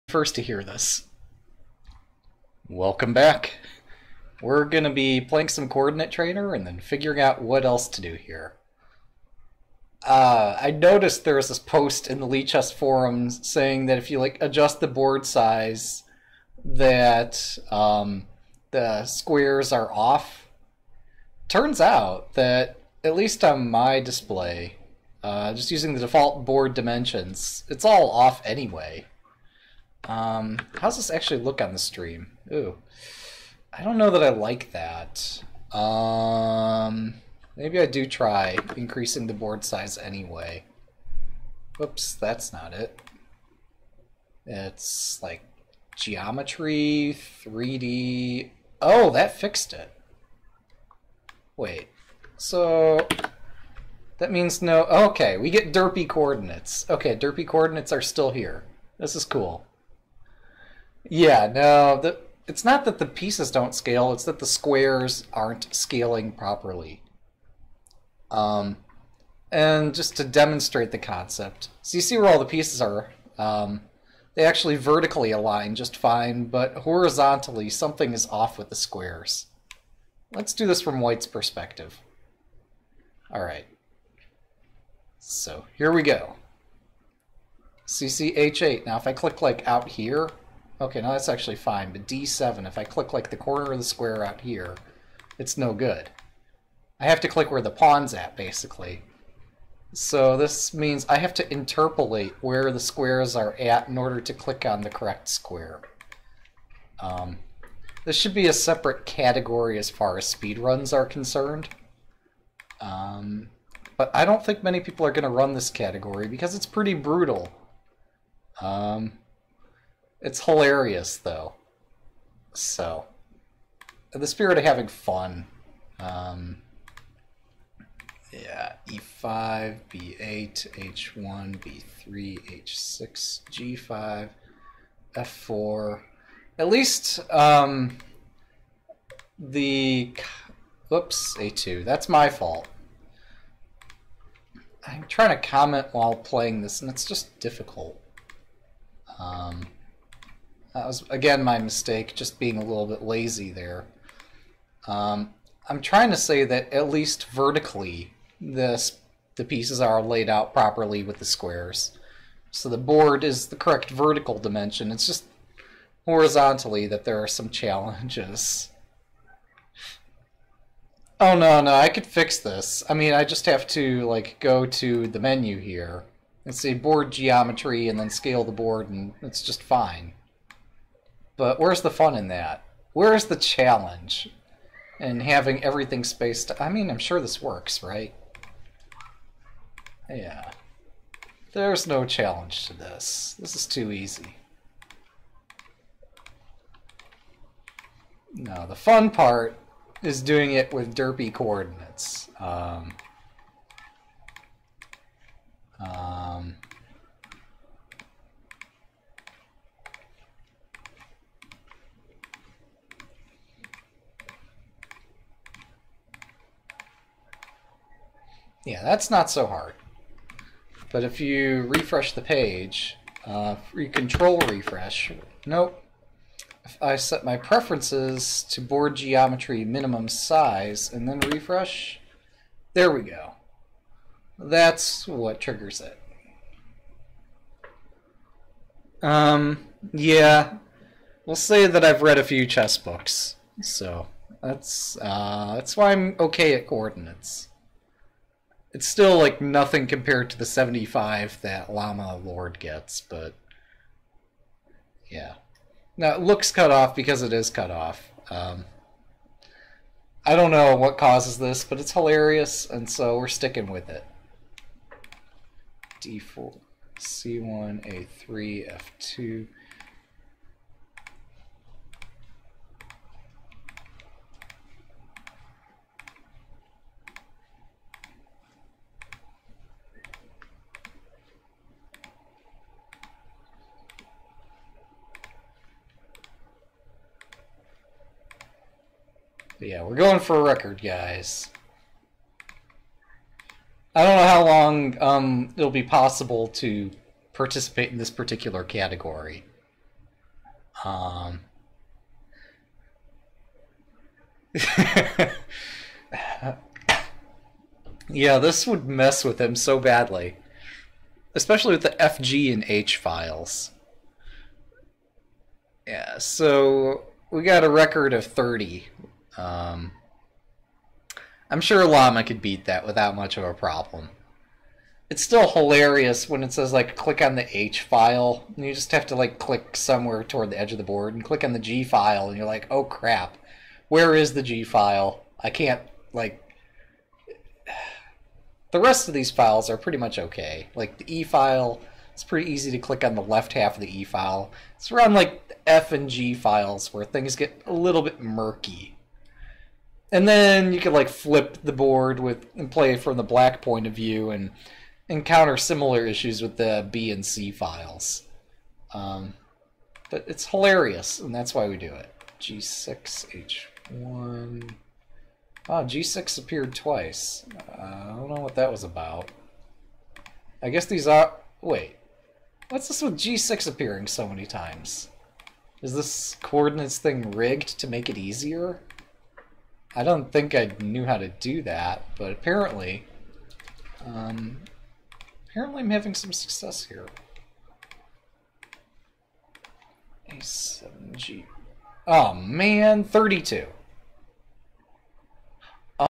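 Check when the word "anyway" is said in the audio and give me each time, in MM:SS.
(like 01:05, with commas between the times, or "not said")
00:28, 00:39.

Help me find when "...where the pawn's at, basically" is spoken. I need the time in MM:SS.
01:37.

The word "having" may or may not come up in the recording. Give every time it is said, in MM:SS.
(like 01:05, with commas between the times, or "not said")
02:04, 03:05, 06:25.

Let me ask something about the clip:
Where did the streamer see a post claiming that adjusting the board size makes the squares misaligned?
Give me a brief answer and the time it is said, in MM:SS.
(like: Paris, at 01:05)
Lichess forums, at 00:12.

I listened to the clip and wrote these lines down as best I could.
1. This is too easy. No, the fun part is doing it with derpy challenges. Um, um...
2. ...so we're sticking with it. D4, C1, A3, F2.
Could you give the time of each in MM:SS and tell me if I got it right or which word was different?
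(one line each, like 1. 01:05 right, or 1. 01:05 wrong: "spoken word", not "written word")
1. 03:13 wrong: "coordinates", not "challenges"
2. 04:22 right.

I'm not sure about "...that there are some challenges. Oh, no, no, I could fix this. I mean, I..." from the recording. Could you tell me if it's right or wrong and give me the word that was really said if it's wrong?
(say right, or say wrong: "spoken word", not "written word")
right.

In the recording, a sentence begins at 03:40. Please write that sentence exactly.
But if you refresh the page, uh, control refresh.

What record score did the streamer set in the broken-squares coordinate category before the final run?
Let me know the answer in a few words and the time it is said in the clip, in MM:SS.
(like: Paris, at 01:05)
30, at 05:18.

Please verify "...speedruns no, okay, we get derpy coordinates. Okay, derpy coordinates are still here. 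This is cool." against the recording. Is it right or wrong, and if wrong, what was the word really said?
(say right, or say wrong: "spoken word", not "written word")
wrong: "means", not "speedruns".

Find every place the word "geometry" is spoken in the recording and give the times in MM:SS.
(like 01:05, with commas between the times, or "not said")
00:45, 02:57, 03:48.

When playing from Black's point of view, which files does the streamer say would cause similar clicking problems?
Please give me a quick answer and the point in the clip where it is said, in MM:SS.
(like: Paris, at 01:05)
B and C files, at 05:56.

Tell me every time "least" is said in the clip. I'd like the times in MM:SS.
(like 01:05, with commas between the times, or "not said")
00:23, 02:16, 02:36.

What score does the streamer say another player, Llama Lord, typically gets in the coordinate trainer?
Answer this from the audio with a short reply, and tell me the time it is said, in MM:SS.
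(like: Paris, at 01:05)
75, at 04:10.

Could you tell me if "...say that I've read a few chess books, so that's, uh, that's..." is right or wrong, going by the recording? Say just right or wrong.
right.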